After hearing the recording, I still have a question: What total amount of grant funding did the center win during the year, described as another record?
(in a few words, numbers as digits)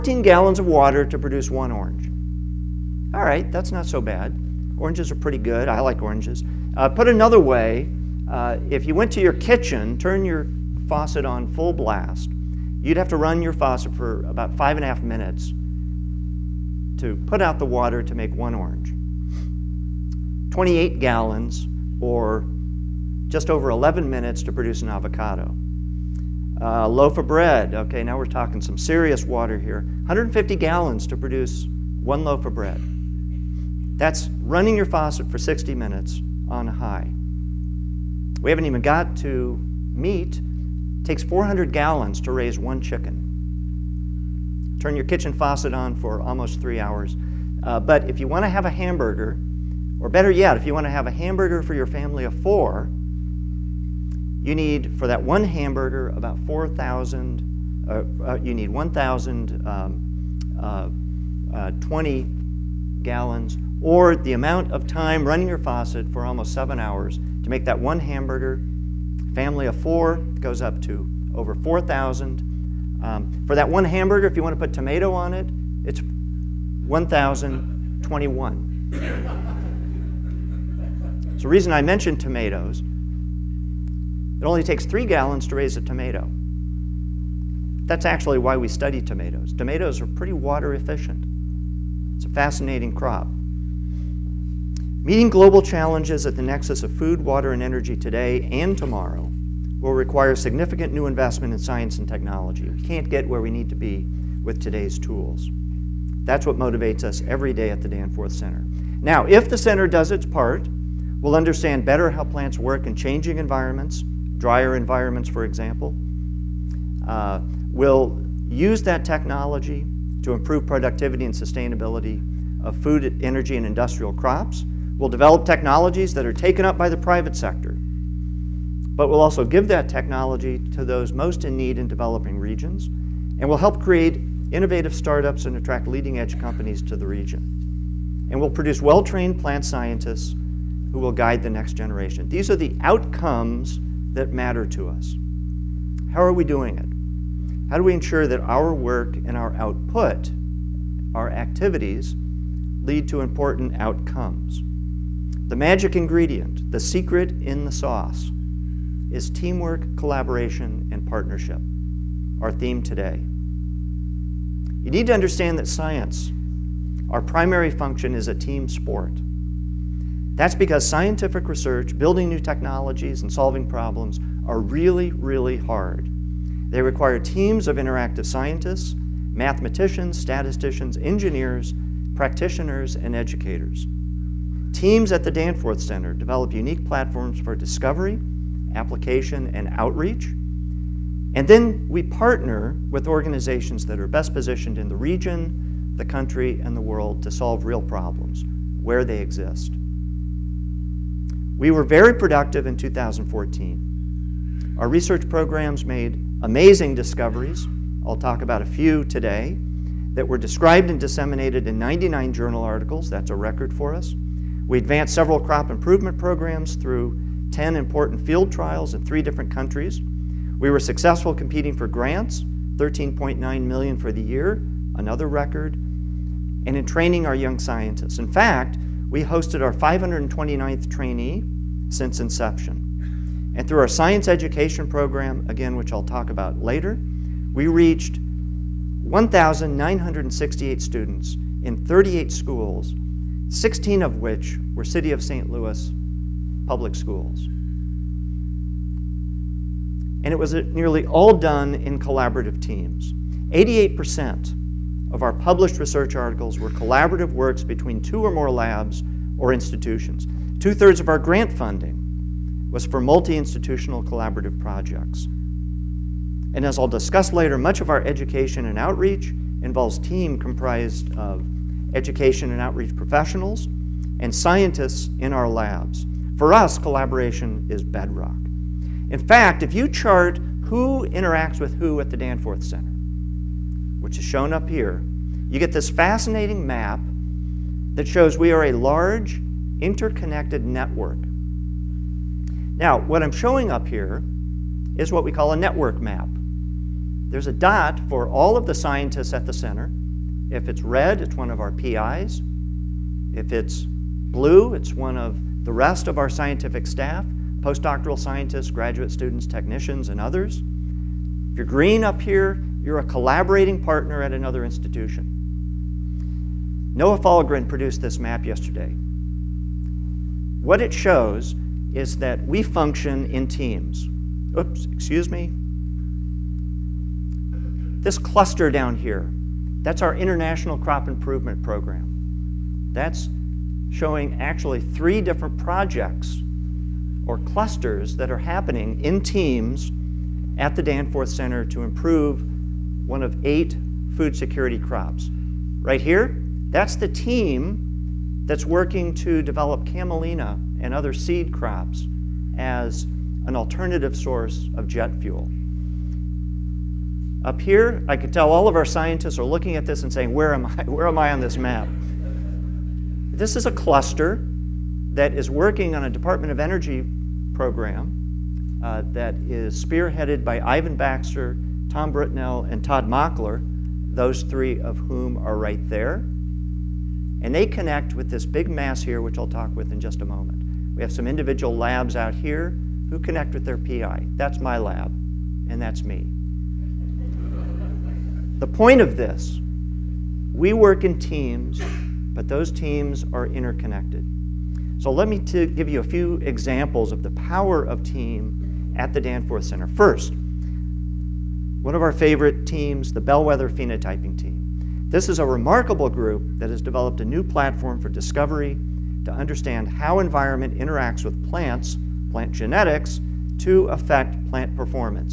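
13.9 million.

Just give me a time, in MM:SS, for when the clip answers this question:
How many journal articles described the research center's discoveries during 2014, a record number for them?
03:31.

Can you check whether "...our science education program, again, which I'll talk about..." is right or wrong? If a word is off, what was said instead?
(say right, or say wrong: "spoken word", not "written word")
right.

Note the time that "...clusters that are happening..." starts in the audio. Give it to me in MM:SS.
05:37.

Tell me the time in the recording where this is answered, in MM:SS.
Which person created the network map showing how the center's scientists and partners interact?
05:16.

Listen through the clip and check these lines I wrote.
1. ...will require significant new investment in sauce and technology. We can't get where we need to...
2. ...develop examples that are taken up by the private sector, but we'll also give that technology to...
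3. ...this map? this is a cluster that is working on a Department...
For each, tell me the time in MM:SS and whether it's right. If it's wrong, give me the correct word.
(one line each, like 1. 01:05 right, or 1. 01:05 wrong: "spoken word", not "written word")
1. 01:39 wrong: "science", not "sauce"
2. 02:05 wrong: "technologies", not "examples"
3. 06:01 right.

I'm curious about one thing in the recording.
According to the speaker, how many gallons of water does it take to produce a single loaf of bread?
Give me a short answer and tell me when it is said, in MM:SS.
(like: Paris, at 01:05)
150, at 00:30.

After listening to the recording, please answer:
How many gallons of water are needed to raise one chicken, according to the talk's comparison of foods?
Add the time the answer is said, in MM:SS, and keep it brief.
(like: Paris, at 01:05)
400, at 00:41.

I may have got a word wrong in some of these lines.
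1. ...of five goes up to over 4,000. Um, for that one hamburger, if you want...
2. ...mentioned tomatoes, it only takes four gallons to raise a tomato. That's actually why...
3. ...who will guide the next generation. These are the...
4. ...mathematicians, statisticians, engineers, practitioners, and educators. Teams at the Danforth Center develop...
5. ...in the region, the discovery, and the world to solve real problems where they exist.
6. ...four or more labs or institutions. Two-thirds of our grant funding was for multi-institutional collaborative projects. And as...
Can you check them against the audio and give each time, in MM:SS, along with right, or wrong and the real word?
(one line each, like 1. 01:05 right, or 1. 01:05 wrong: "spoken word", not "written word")
1. 01:09 wrong: "four", not "five"
2. 01:21 wrong: "three", not "four"
3. 02:20 right
4. 02:59 right
5. 03:14 wrong: "country", not "discovery"
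6. 04:17 wrong: "two", not "four".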